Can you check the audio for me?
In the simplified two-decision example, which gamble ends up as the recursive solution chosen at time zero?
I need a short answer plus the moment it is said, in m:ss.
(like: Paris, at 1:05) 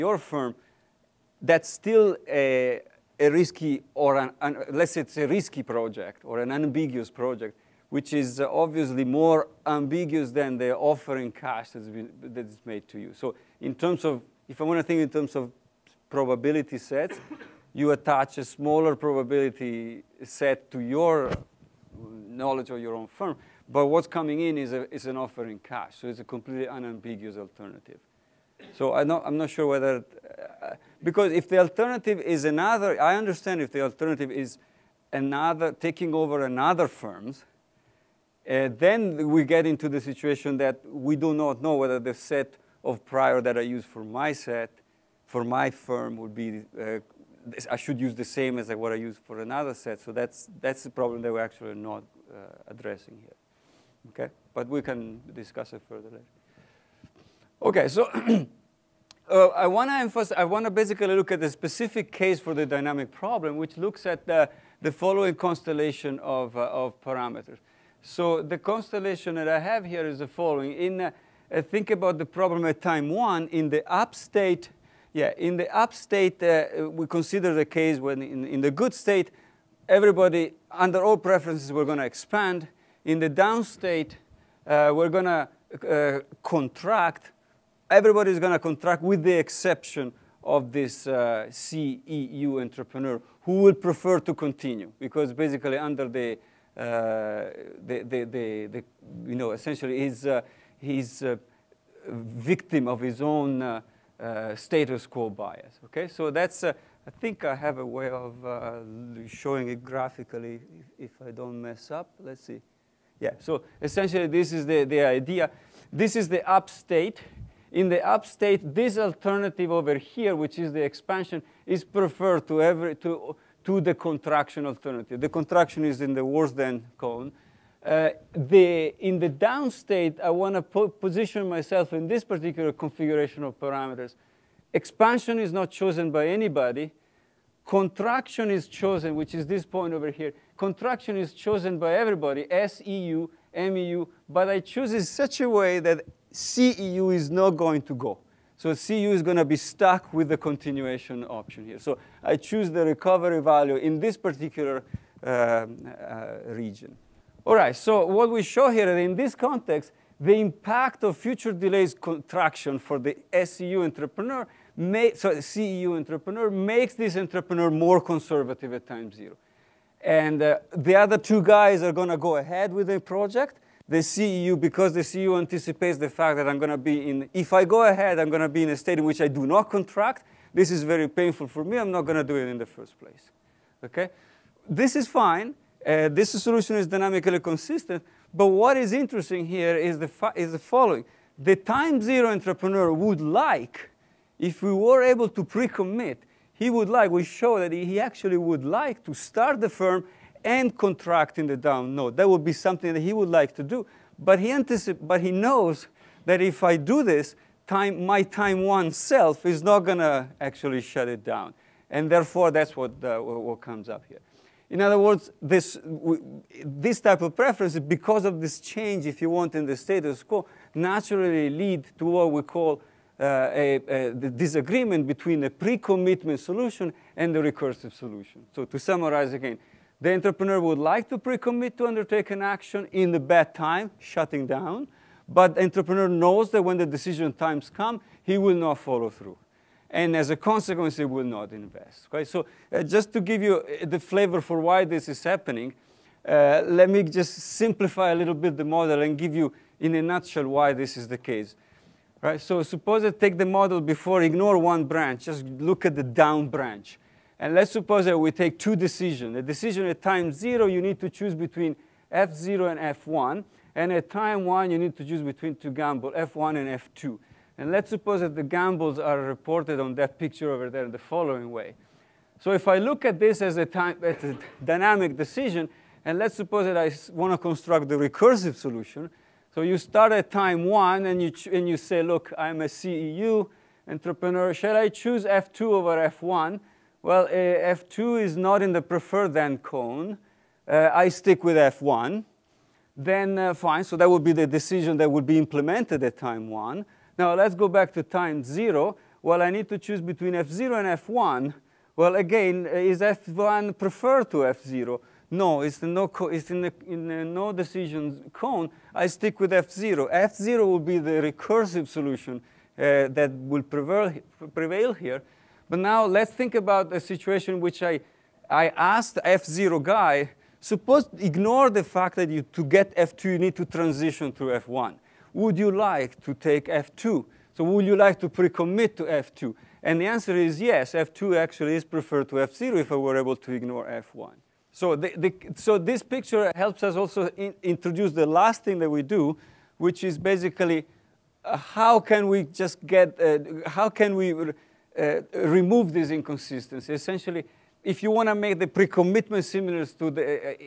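f0, at 5:10.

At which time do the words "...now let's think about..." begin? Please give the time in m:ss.
5:15.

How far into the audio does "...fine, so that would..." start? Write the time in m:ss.
4:53.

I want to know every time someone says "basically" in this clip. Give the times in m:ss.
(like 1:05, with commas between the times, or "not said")
1:00, 1:35, 5:40.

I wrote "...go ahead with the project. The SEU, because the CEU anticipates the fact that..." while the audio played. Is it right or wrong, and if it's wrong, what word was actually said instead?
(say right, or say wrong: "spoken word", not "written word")
wrong: "CEU", not "SEU".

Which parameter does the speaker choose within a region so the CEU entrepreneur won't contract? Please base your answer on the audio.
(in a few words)
Recovery value.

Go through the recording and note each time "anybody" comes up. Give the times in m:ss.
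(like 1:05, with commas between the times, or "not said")
2:16.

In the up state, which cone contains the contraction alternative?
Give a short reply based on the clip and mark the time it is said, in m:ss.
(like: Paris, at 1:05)
Worse than cone, at 2:06.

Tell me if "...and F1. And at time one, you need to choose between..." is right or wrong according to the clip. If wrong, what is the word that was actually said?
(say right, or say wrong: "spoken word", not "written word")
right.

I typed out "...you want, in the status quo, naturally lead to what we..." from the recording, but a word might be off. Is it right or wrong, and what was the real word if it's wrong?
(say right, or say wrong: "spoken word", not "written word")
right.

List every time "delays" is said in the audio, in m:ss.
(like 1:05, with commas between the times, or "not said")
2:41.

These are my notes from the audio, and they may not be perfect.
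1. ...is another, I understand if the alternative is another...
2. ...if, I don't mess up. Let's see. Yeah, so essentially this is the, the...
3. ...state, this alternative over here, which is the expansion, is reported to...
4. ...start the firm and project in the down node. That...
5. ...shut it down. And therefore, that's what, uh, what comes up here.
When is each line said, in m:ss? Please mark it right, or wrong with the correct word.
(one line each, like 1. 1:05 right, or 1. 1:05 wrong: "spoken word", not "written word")
1. 0:32 right
2. 1:51 right
3. 1:58 wrong: "preferred", not "reported"
4. 3:19 wrong: "contract", not "project"
5. 3:30 right.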